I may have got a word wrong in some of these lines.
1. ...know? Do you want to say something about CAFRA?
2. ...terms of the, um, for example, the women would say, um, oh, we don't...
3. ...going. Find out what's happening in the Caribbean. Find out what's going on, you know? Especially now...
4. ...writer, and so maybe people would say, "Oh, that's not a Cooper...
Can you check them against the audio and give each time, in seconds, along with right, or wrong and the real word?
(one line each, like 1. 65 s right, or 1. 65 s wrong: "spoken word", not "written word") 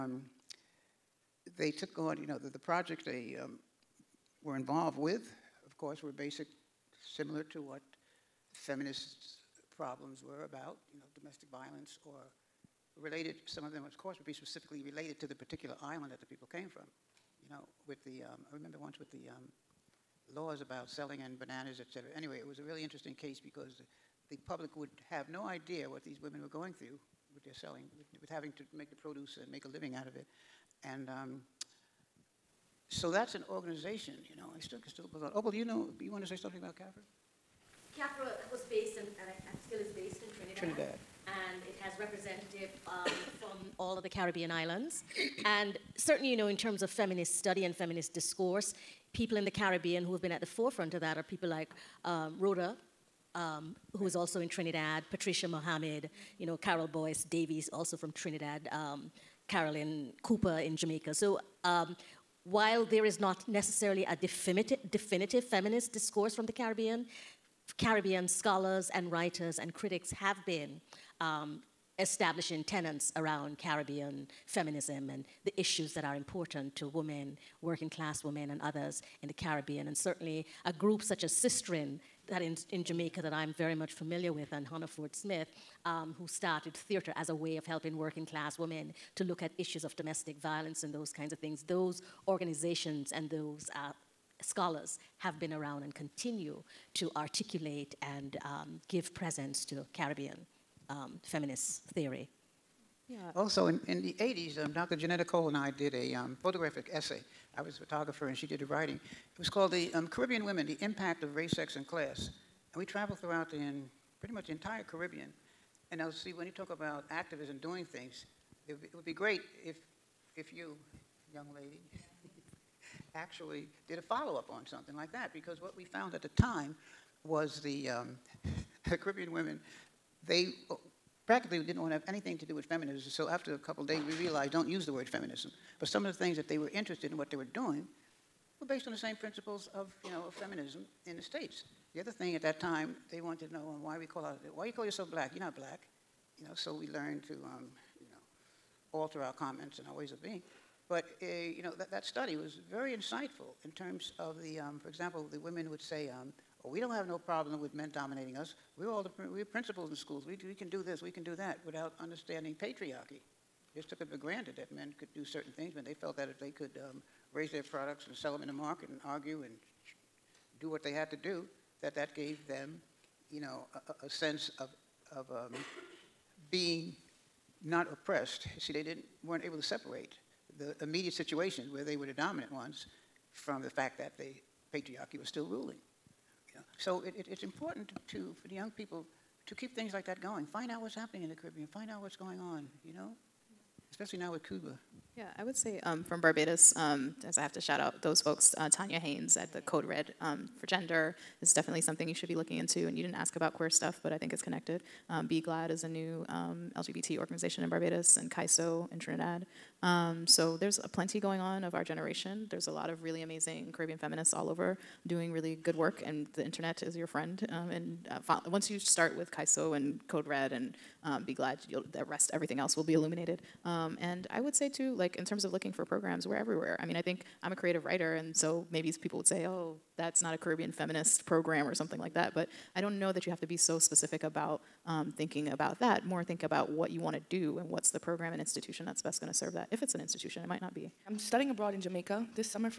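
1. 35 s right
2. 153 s right
3. 190 s right
4. 227 s wrong: "Caribbean", not "Cooper".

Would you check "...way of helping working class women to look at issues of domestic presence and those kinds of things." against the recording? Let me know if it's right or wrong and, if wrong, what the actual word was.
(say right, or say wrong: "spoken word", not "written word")
wrong: "violence", not "presence".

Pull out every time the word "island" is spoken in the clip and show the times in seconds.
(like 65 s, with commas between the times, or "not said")
15 s, 44 s.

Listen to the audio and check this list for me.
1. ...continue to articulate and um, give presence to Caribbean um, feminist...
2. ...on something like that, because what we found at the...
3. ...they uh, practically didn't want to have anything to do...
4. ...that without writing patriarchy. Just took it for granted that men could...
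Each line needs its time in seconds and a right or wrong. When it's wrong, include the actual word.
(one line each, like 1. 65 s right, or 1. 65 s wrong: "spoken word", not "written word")
1. 95 s right
2. 124 s right
3. 130 s right
4. 161 s wrong: "understanding", not "writing".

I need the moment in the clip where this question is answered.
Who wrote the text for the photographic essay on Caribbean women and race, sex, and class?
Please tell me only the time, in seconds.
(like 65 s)
104 s.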